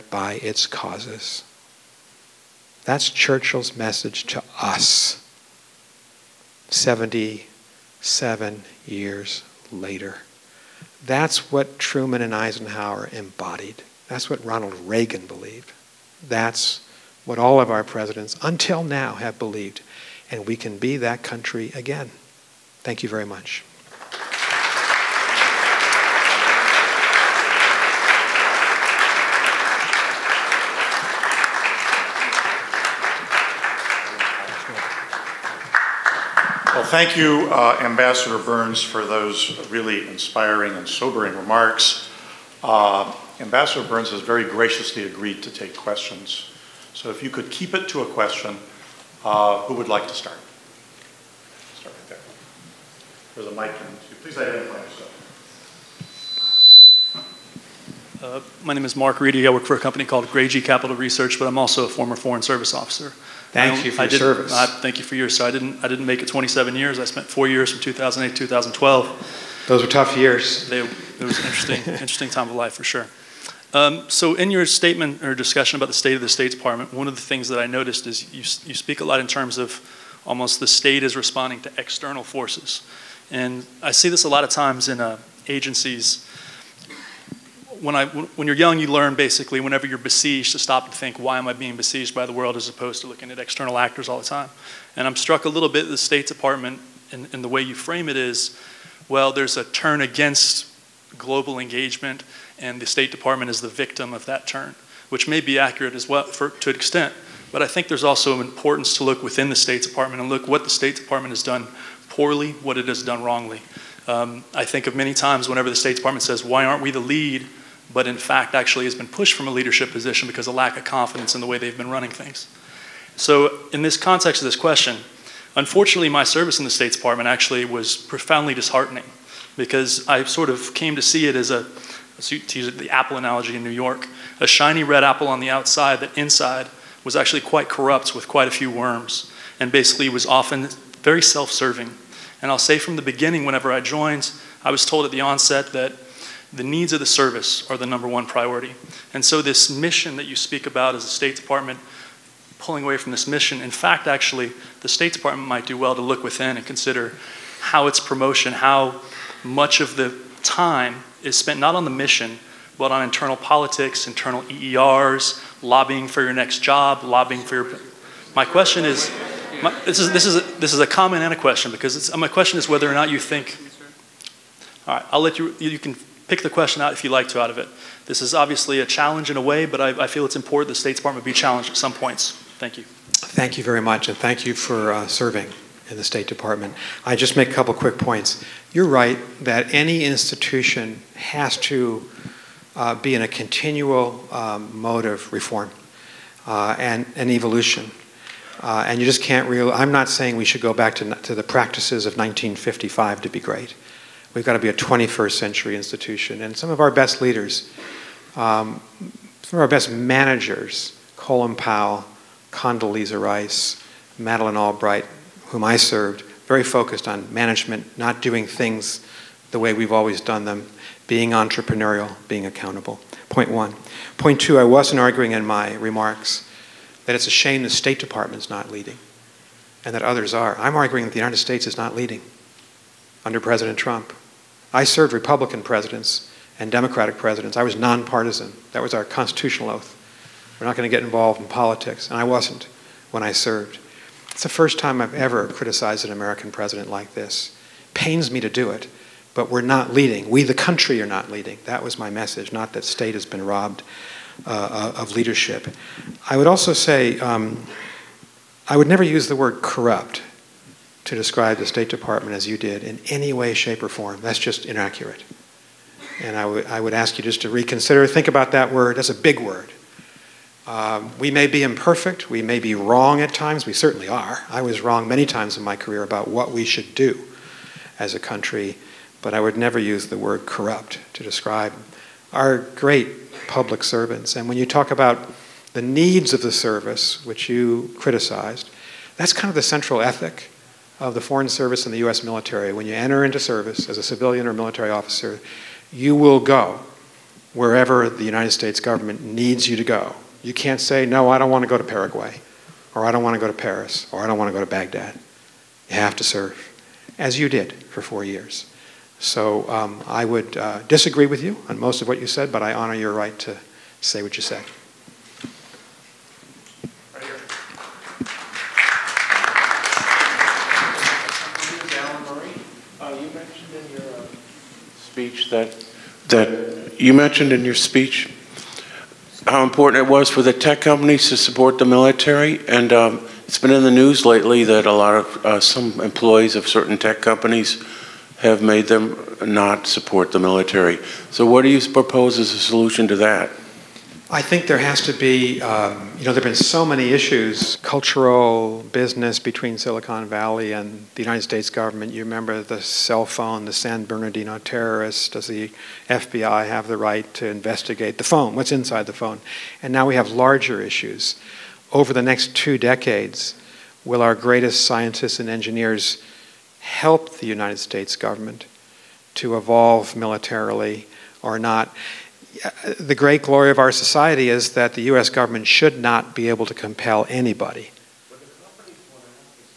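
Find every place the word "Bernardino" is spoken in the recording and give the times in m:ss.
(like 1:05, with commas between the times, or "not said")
5:54.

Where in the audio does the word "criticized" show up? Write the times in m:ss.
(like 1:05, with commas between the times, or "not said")
4:05, 4:47.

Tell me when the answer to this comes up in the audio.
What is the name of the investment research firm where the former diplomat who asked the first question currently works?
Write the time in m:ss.
1:00.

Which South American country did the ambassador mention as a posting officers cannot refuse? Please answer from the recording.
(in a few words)
Paraguay.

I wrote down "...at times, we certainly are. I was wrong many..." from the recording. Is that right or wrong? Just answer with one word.
right.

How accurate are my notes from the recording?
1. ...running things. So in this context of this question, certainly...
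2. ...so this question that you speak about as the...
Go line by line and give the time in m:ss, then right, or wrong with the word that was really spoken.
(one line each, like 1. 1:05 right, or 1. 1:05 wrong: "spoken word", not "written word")
1. 2:01 wrong: "unfortunately", not "certainly"
2. 2:29 wrong: "mission", not "question".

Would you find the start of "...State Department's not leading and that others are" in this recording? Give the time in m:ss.
3:47.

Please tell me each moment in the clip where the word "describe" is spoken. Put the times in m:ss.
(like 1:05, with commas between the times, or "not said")
4:21, 4:41.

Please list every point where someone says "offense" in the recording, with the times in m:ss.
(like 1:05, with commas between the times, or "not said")
not said.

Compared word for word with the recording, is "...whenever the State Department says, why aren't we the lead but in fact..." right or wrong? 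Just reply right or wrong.
right.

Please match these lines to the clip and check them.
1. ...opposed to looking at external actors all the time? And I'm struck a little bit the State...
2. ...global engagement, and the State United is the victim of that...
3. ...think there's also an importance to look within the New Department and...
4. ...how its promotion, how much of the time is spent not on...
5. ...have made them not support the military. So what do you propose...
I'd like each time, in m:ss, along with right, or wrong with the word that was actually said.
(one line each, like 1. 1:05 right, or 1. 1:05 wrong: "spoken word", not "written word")
1. 1:32 right
2. 1:41 wrong: "Department", not "United"
3. 1:47 wrong: "State", not "New"
4. 2:37 right
5. 5:38 right.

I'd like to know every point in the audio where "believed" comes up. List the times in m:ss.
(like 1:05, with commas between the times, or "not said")
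0:15, 0:19.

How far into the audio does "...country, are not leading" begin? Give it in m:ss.
4:10.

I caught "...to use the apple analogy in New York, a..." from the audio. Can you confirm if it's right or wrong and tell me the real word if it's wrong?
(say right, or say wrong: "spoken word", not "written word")
right.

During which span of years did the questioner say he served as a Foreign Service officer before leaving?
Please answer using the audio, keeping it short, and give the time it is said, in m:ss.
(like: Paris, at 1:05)
2008 to 2012, at 1:07.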